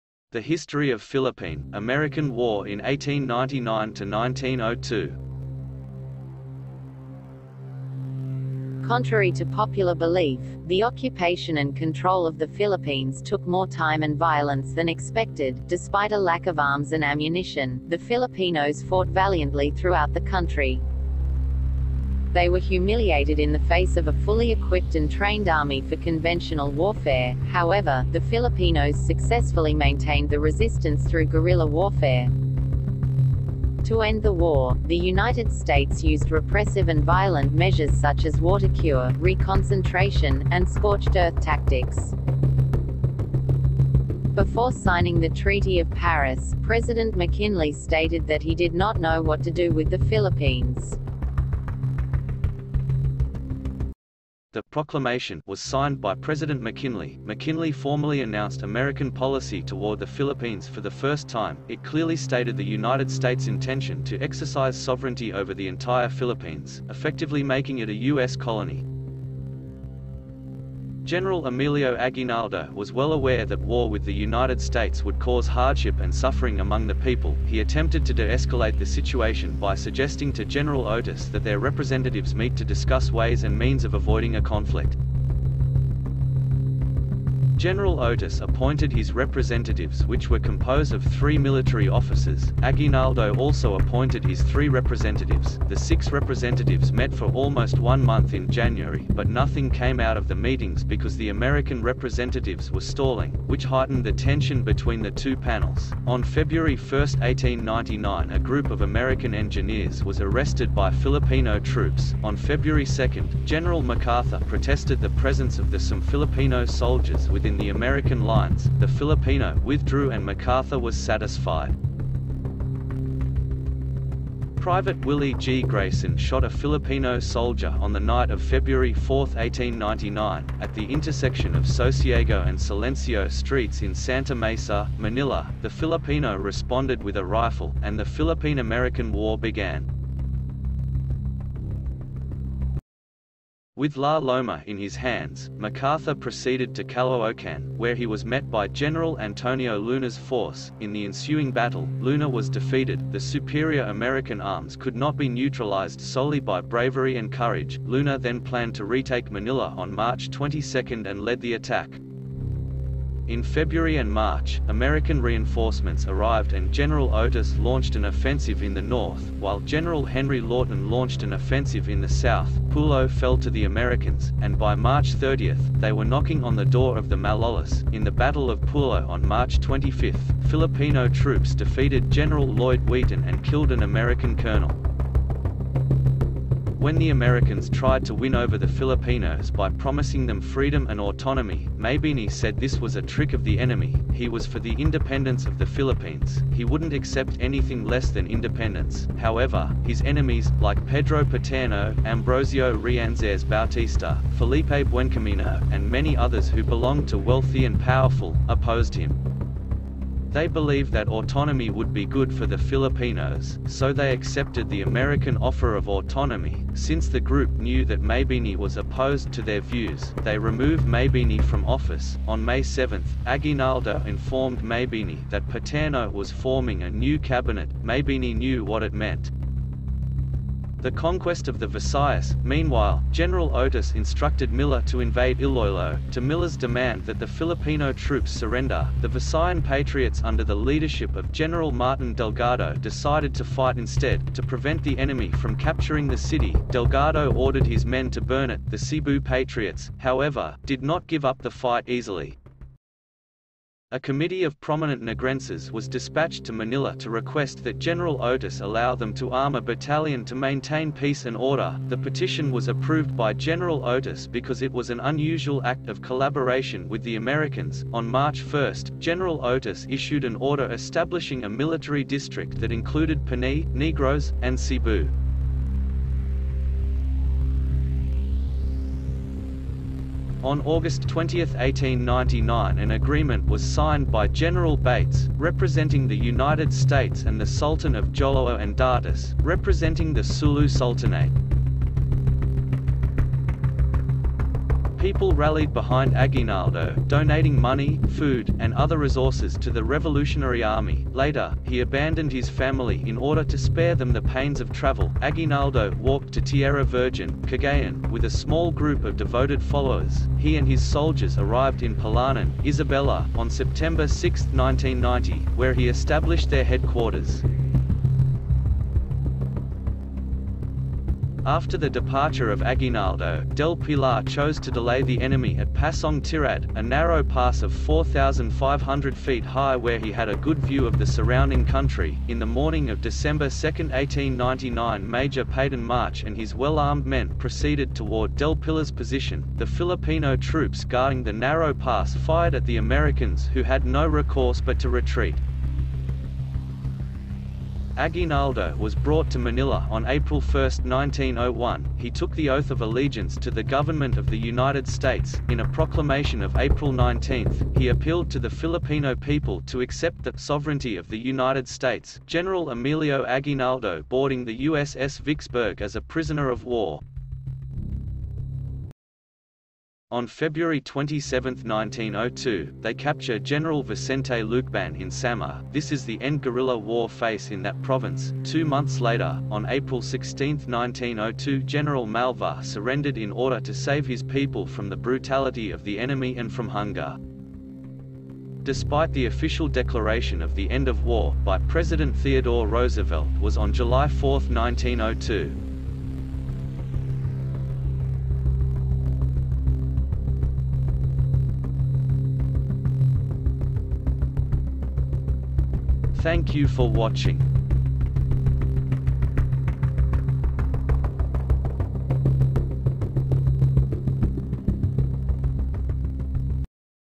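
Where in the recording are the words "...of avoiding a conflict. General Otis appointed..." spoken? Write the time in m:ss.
1:23.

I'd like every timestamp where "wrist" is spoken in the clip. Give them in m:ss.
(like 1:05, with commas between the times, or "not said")
not said.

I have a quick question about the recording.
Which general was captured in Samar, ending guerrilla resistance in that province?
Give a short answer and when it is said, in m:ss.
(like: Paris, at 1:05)
Vicente Lucban, at 6:13.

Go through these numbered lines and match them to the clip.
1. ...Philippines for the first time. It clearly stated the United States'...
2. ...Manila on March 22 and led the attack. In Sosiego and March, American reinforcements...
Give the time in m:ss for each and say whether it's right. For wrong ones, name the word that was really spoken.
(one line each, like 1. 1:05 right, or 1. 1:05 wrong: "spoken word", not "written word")
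1. 1:00 right
2. 2:39 wrong: "February", not "Sosiego".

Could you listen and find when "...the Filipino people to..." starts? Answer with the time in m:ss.
5:58.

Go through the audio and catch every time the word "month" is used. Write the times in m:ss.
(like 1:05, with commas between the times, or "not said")
1:38, 6:18.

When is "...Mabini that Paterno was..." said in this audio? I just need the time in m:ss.
3:44.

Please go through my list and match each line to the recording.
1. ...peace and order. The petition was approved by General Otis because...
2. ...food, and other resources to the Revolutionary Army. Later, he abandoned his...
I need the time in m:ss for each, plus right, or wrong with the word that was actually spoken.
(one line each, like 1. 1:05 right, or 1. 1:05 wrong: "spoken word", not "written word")
1. 4:20 right
2. 4:58 right.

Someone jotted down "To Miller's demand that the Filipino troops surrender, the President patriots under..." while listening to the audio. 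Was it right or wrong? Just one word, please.
wrong.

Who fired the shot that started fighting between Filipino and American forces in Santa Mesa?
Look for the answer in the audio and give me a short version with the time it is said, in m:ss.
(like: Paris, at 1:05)
Willie G. Grayson, at 2:05.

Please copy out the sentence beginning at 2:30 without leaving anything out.
In the ensuing battle, Luna was defeated.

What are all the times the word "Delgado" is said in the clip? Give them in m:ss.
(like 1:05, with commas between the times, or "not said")
4:02, 4:06.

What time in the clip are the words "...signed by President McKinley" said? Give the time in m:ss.
0:55.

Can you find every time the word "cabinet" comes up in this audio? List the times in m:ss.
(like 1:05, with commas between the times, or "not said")
3:47.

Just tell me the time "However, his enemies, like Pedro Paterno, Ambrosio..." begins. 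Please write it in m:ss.
3:19.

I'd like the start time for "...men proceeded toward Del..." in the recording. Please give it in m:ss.
5:37.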